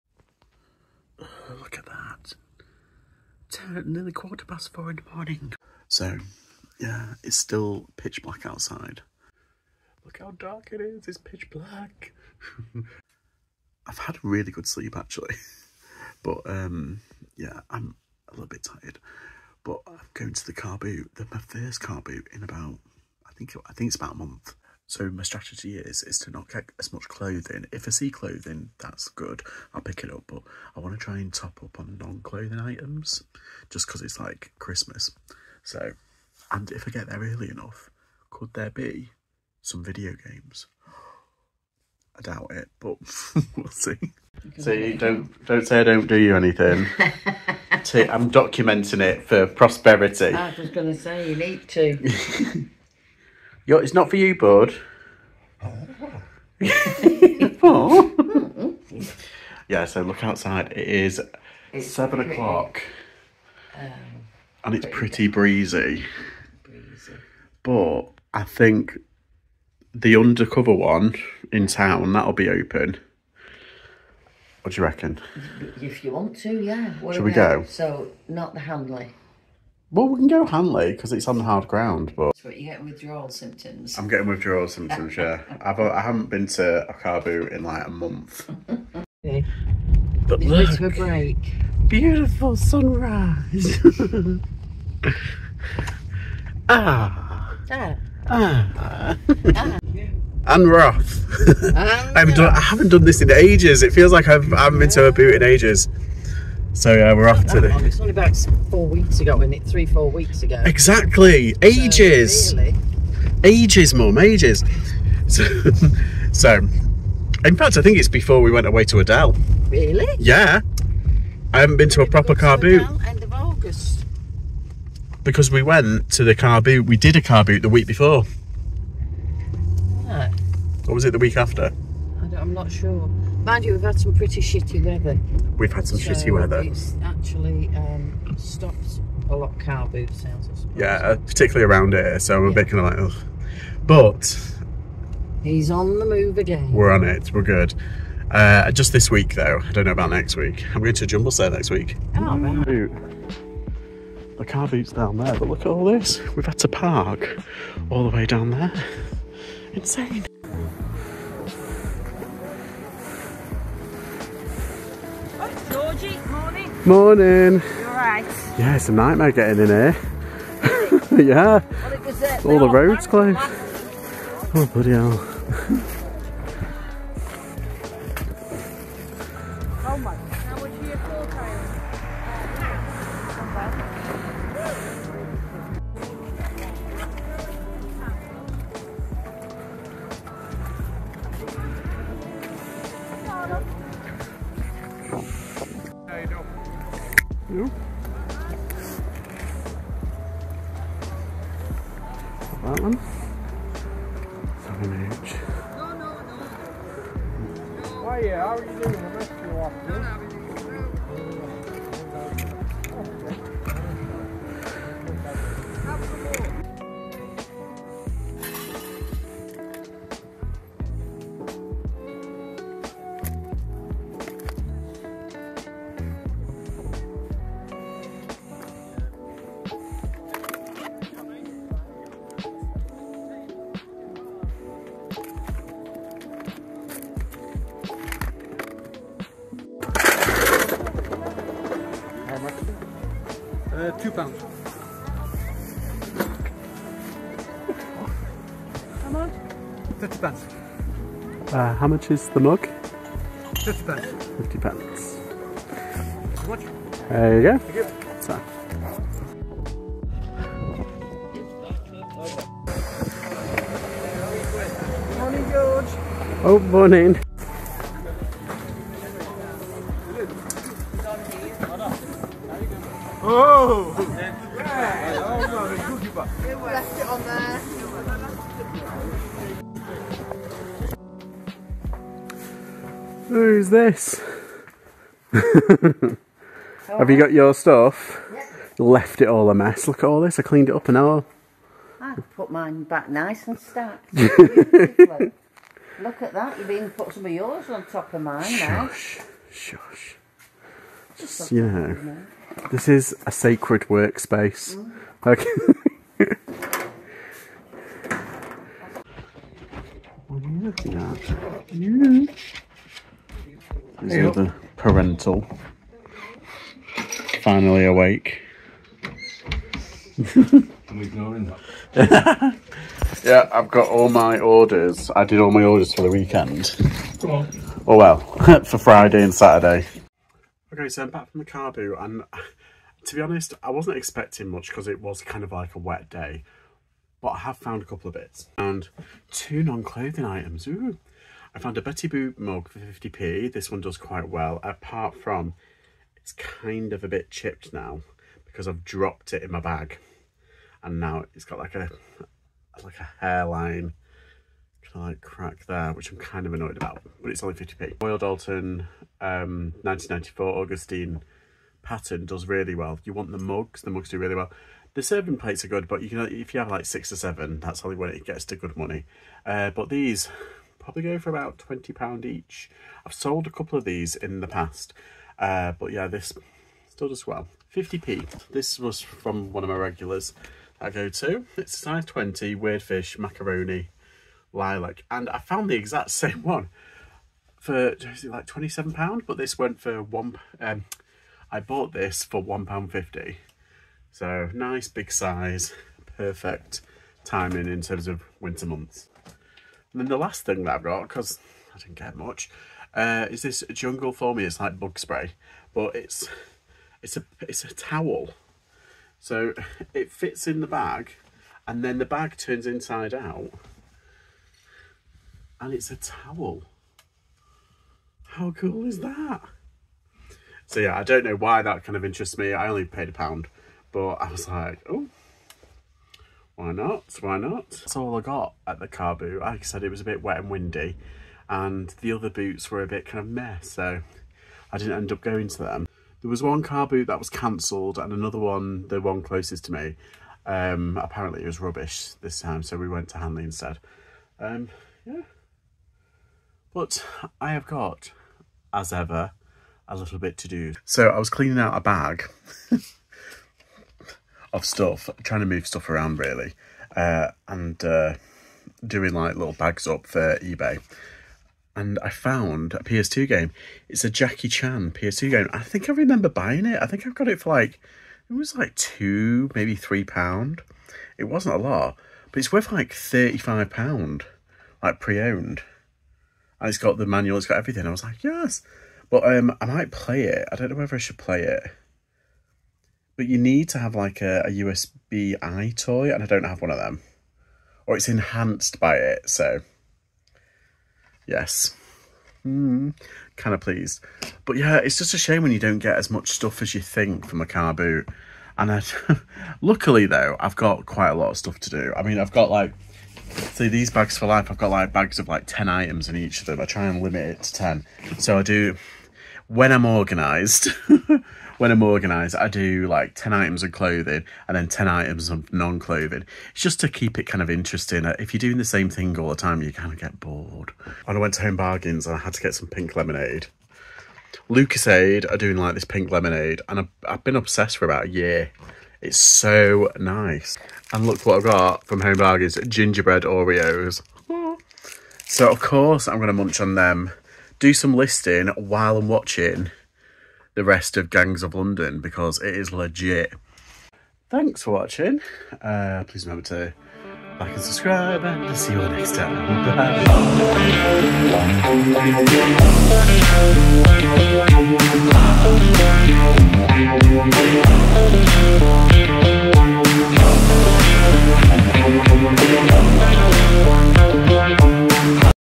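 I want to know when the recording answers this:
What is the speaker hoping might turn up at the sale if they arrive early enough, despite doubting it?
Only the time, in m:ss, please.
0:39.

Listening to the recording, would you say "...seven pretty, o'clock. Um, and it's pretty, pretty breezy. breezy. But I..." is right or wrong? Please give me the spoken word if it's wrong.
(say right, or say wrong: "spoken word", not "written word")
right.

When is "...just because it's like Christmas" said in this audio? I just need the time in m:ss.
0:33.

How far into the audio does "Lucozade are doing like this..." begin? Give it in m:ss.
8:44.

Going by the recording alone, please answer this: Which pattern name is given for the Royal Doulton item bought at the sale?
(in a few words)
Augustine.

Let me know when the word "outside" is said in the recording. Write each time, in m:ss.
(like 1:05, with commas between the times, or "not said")
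0:08, 1:00.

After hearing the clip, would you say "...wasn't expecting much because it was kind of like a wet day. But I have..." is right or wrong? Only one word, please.
right.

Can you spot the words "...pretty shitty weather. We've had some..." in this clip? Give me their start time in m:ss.
2:14.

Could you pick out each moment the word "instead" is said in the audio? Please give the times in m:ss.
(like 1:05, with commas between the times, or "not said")
7:23.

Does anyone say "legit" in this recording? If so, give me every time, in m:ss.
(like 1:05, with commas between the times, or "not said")
9:02.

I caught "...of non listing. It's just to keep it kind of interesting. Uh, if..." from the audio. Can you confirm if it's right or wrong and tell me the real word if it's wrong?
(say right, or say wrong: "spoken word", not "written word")
wrong: "clothing", not "listing".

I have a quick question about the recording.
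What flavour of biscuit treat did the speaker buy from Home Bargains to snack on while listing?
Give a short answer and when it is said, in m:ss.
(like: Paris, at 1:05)
gingerbread Oreos, at 8:52.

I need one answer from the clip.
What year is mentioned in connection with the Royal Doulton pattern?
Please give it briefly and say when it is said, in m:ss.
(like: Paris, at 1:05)
1994, at 5:59.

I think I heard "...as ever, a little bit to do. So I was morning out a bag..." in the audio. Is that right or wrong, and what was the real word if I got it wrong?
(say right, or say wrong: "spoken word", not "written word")
wrong: "cleaning", not "morning".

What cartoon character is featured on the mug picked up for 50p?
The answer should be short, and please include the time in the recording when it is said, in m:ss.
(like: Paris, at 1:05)
Betty Boop, at 5:41.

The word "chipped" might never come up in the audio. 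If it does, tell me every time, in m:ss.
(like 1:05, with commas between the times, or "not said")
5:47.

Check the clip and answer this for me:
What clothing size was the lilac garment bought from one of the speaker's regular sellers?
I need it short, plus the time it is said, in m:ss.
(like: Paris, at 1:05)
20, at 6:21.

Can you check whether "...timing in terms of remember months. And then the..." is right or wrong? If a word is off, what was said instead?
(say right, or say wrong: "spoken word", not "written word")
wrong: "winter", not "remember".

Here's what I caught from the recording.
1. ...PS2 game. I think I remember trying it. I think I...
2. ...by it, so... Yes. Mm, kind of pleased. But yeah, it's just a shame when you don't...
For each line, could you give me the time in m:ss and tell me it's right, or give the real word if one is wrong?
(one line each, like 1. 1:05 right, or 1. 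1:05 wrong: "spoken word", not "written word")
1. 7:44 wrong: "buying", not "trying"
2. 8:08 right.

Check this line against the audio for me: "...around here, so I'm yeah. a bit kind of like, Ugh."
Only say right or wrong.
right.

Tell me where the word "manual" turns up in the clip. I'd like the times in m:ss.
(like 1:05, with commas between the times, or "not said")
7:57.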